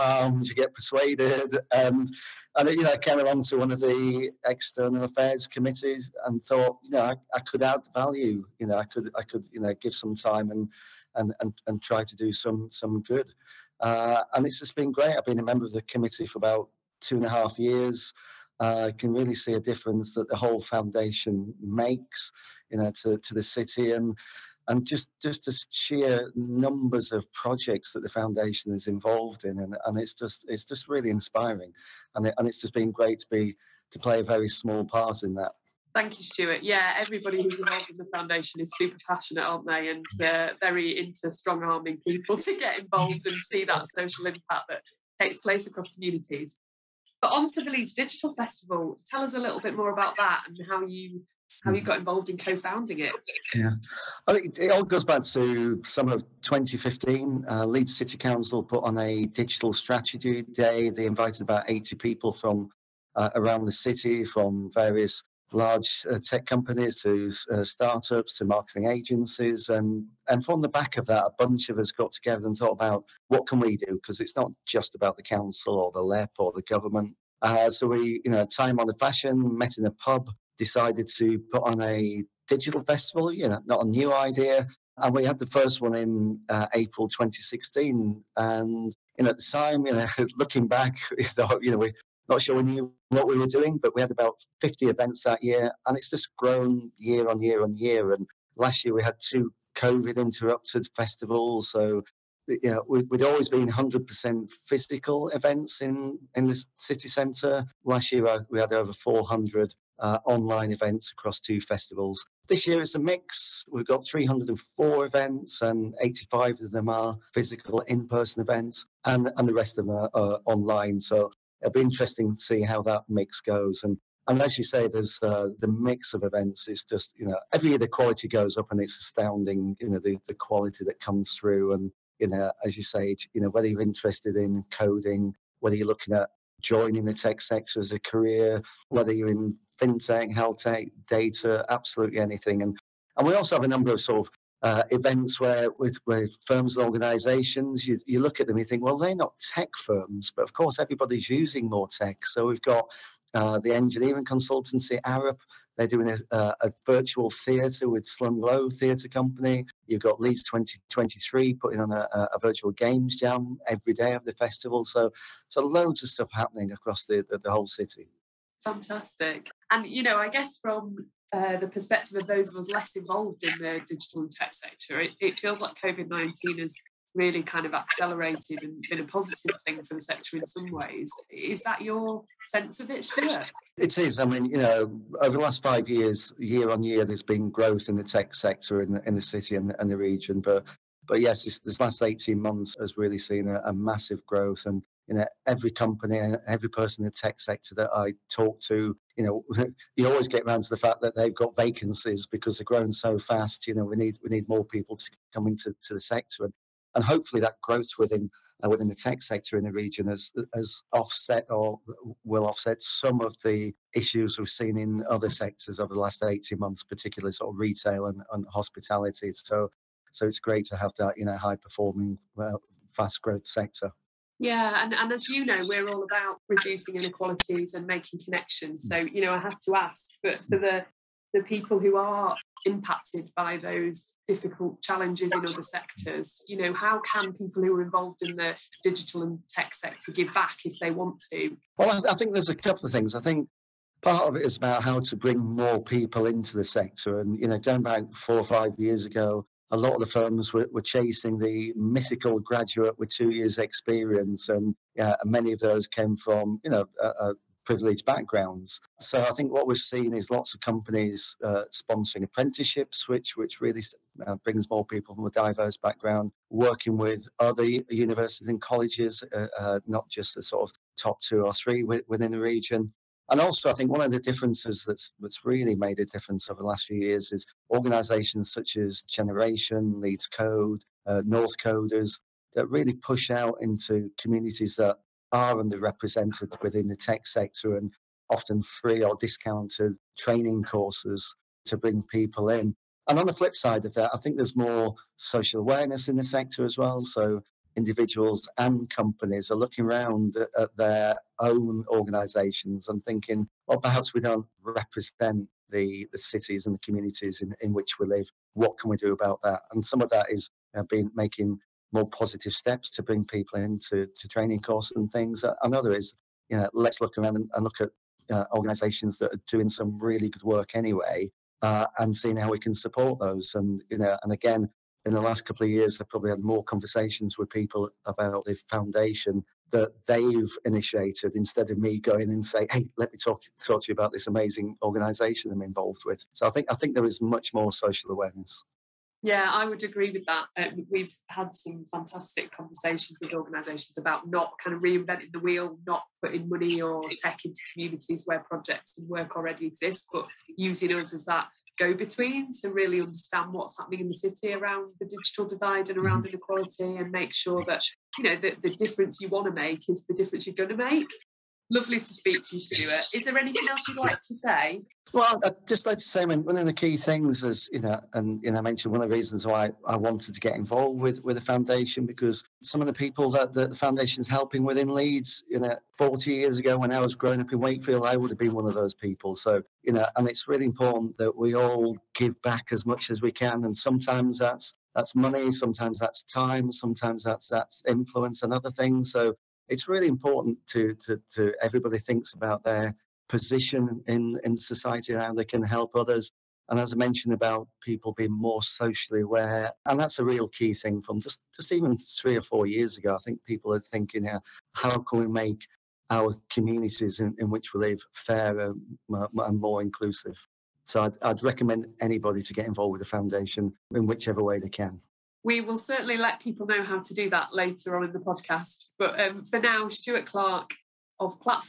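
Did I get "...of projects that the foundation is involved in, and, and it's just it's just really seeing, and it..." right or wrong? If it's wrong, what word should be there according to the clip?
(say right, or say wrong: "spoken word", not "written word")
wrong: "inspiring", not "seeing".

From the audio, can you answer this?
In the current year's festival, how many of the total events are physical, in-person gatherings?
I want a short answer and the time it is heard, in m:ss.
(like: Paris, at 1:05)
85, at 1:56.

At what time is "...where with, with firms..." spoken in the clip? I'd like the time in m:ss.
2:25.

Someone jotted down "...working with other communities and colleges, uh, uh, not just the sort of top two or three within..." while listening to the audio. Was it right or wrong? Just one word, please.
wrong.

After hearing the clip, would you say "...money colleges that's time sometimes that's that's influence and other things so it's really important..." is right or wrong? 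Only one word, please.
wrong.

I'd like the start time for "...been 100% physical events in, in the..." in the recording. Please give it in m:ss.
1:43.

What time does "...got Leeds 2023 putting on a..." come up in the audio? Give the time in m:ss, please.
2:40.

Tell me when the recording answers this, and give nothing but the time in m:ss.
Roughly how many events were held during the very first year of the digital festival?
1:34.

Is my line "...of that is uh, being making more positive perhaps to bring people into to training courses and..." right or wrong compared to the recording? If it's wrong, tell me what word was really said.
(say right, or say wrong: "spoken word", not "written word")
wrong: "steps", not "perhaps".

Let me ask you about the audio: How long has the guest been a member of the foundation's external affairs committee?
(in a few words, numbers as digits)
2.5 years.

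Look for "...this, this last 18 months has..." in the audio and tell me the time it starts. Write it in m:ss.
3:11.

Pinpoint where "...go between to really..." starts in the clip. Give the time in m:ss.
5:51.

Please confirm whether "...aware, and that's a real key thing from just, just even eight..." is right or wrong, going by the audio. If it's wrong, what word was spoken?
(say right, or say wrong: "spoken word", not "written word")
wrong: "three", not "eight".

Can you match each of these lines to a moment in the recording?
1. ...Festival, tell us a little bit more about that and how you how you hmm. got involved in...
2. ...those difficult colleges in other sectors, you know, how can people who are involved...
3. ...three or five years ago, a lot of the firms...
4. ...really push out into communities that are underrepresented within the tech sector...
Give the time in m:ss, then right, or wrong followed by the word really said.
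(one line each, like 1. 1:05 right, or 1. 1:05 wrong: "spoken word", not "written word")
1. 0:48 right
2. 3:53 wrong: "challenges", not "colleges"
3. 4:08 wrong: "four", not "three"
4. 4:42 right.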